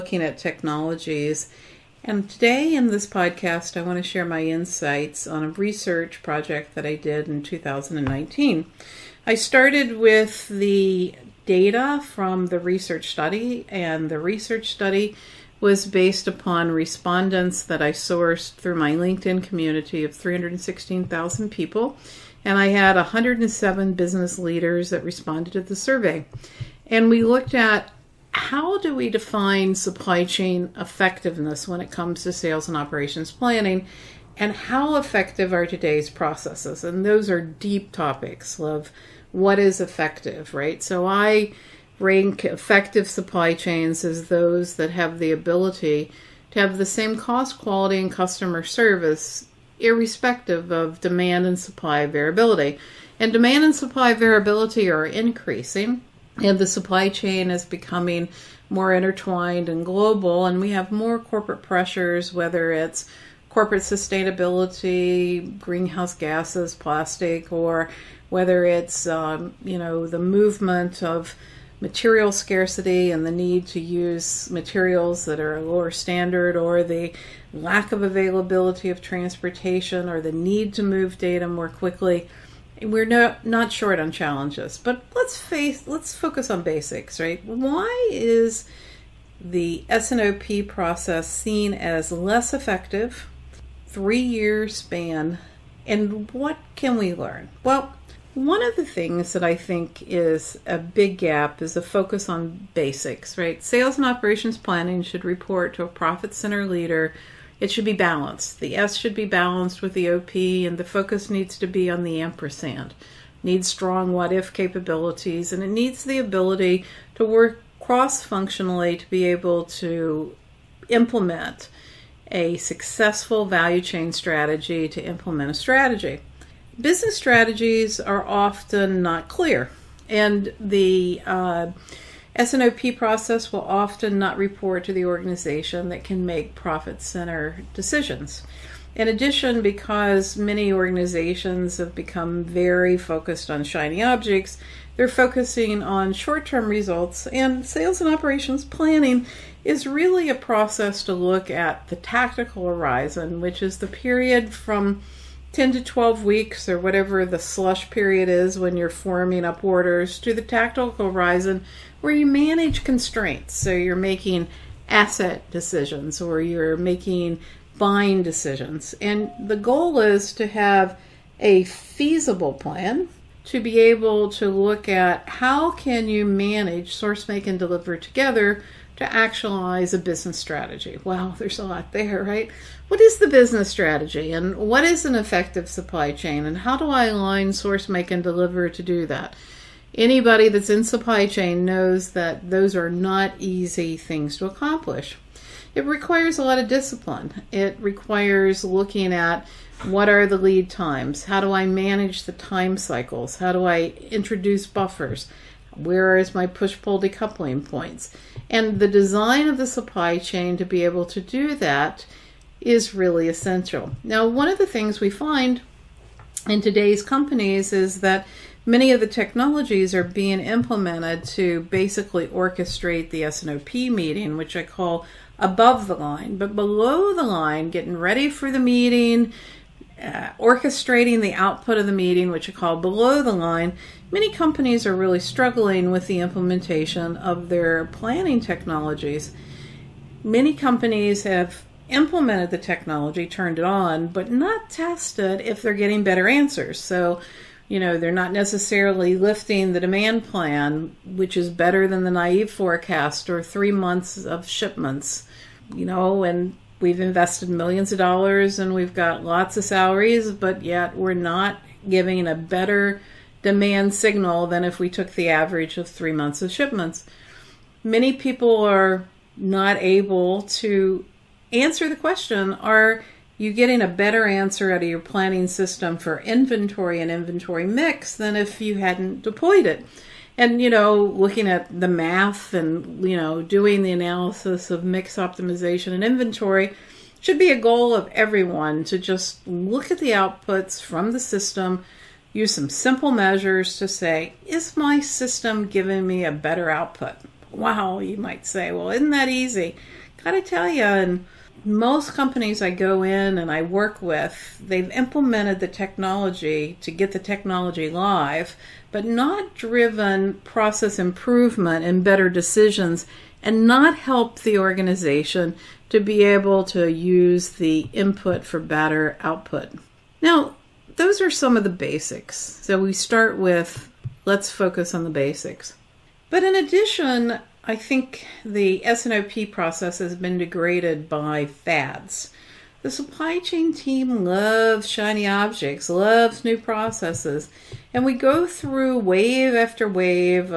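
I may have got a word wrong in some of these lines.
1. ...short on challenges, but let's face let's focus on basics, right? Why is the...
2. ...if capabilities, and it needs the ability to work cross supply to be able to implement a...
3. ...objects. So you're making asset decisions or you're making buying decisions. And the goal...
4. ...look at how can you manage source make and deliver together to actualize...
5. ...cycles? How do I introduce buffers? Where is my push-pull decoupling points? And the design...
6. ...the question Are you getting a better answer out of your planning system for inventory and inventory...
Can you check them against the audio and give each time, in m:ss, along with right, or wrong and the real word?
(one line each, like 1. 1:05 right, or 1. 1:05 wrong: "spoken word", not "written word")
1. 1:23 right
2. 1:54 wrong: "functionally", not "supply"
3. 2:42 wrong: "constraints", not "objects"
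4. 2:54 right
5. 3:22 right
6. 4:31 right.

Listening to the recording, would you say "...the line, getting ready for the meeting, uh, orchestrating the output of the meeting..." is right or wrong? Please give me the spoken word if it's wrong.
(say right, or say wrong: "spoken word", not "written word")
right.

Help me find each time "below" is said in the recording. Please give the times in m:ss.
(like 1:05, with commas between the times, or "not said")
3:46, 3:52.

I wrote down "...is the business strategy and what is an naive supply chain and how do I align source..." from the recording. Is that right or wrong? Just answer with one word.
wrong.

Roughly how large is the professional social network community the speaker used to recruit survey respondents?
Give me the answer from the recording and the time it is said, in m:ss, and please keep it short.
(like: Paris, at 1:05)
316,000, at 0:20.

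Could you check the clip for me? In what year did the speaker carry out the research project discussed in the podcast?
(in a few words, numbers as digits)
2019.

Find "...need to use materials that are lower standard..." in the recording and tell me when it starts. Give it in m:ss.
1:13.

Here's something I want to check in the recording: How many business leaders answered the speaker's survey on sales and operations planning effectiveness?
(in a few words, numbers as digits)
107.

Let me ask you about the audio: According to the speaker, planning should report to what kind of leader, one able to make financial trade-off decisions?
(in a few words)
profit center leader.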